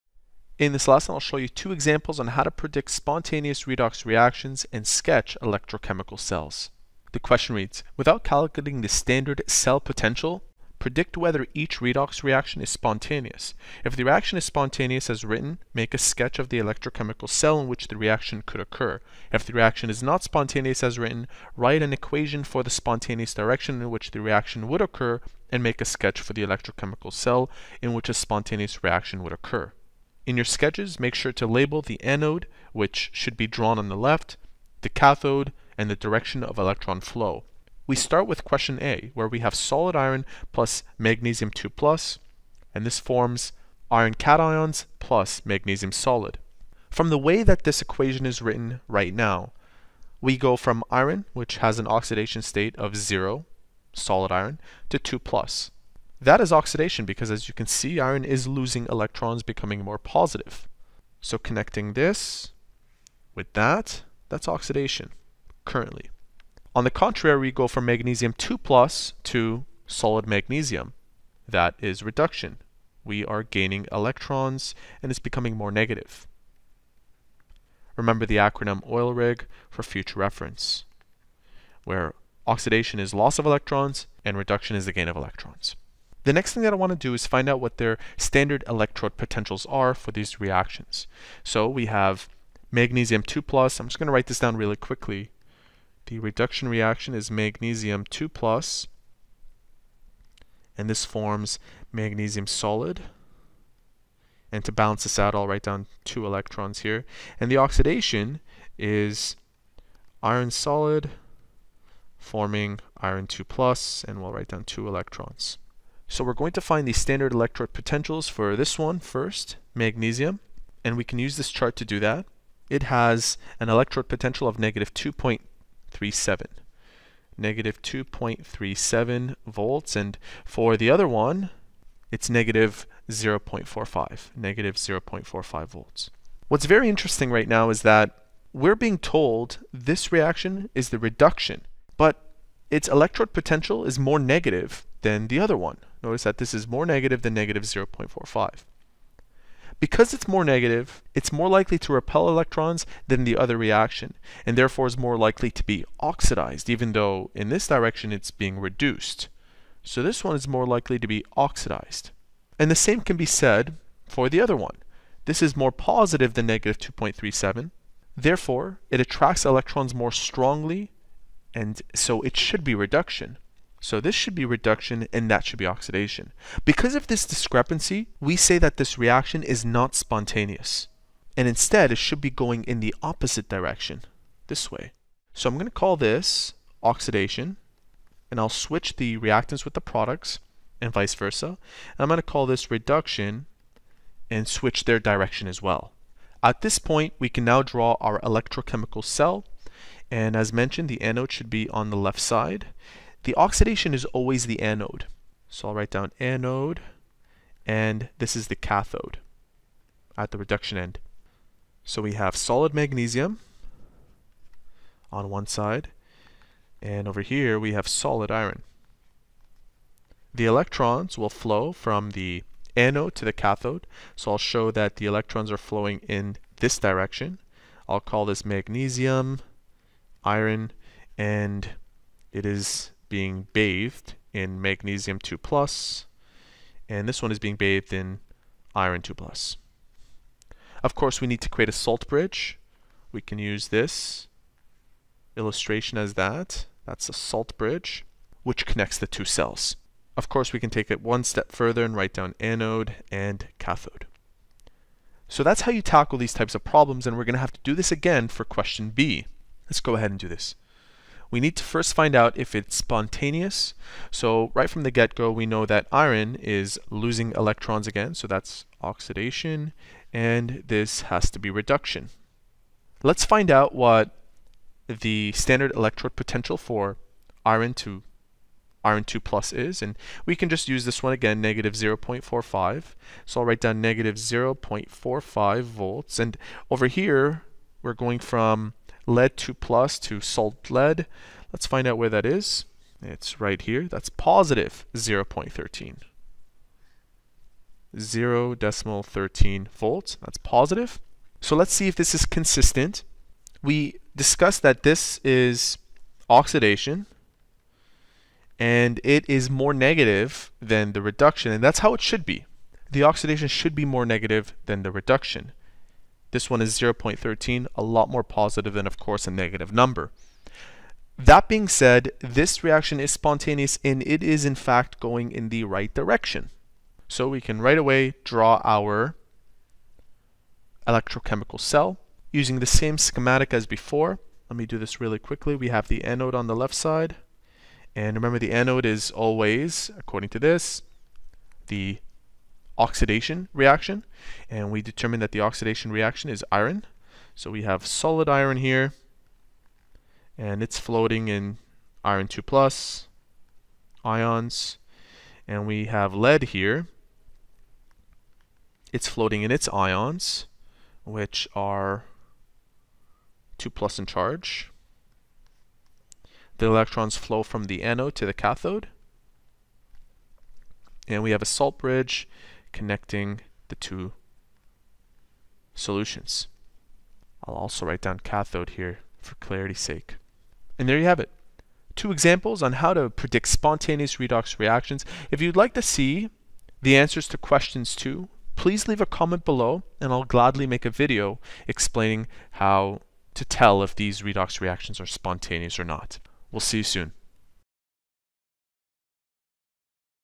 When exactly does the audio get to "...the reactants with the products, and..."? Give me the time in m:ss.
3:08.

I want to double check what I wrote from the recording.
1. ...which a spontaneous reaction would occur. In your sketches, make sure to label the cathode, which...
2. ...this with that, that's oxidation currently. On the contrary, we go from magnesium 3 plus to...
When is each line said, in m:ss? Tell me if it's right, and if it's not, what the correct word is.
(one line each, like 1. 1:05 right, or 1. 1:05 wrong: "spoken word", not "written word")
1. 0:27 wrong: "anode", not "cathode"
2. 1:01 wrong: "2", not "3".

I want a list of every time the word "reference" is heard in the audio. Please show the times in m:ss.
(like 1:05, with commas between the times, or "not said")
1:20.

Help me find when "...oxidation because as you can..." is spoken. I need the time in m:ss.
0:56.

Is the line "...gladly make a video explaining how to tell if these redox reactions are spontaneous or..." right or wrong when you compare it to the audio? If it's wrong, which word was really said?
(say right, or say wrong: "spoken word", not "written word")
right.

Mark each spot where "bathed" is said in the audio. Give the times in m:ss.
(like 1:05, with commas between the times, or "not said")
3:53, 3:57.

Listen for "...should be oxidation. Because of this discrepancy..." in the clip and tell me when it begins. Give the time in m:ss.
2:55.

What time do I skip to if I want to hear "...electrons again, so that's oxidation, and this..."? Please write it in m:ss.
4:27.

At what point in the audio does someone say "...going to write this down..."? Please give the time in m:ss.
1:33.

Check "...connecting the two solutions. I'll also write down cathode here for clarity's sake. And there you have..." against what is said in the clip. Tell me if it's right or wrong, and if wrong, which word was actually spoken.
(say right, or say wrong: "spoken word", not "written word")
right.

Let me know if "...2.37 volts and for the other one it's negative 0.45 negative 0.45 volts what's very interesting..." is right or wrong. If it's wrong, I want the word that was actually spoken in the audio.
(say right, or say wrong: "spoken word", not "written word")
right.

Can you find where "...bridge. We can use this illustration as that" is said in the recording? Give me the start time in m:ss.
4:02.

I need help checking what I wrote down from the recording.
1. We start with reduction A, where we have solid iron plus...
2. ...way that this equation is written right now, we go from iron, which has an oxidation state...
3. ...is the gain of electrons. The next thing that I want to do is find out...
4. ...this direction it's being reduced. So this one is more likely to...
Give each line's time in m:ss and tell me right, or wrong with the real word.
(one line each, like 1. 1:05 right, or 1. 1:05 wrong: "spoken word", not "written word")
1. 0:37 wrong: "question", not "reduction"
2. 0:47 right
3. 1:24 right
4. 2:37 right.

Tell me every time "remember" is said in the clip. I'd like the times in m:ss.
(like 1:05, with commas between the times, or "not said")
1:17, 5:38.